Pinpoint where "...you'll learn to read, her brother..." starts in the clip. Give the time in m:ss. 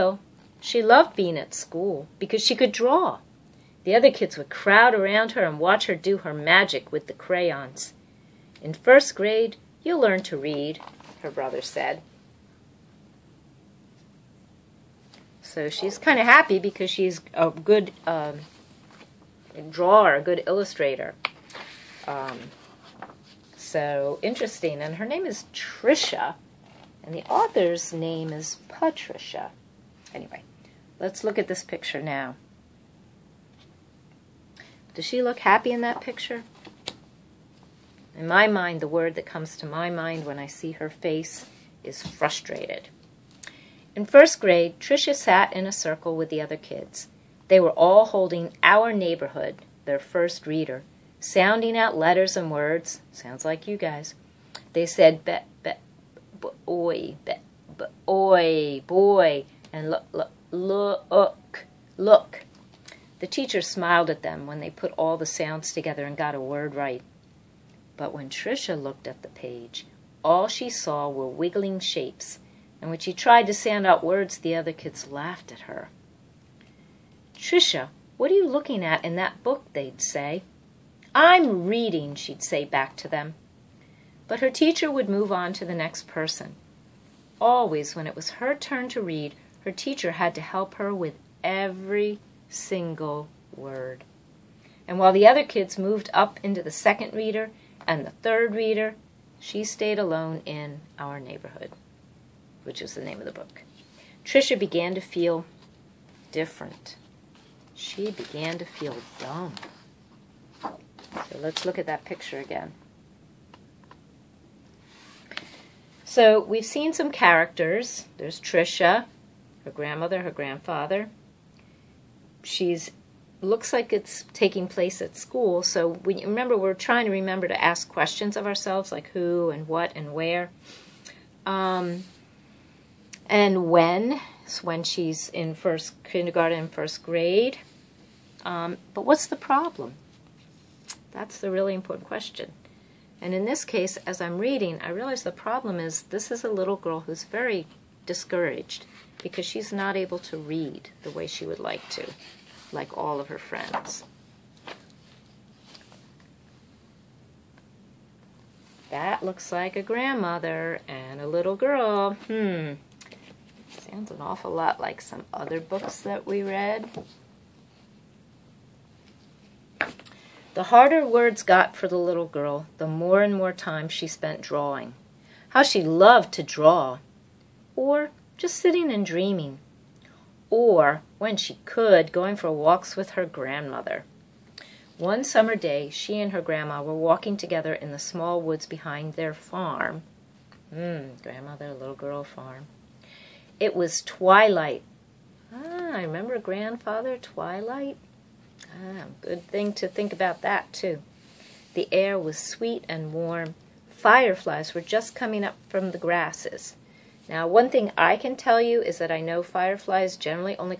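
0:09.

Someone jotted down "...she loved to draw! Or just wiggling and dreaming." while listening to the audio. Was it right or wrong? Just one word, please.
wrong.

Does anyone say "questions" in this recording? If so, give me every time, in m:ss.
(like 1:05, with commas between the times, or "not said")
2:07, 2:22.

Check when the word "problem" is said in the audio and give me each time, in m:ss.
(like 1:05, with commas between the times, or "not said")
2:19, 2:25.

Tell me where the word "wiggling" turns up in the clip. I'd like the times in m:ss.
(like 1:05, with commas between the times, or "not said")
1:11.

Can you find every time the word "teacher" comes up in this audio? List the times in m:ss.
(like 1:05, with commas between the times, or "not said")
1:03, 1:24, 1:29.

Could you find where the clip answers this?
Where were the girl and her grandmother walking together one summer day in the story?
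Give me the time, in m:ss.
3:07.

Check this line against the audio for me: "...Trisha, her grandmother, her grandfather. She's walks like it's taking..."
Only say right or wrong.
wrong.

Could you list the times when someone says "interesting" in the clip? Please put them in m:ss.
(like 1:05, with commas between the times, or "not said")
0:24.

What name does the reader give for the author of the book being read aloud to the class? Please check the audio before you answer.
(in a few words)
Patricia.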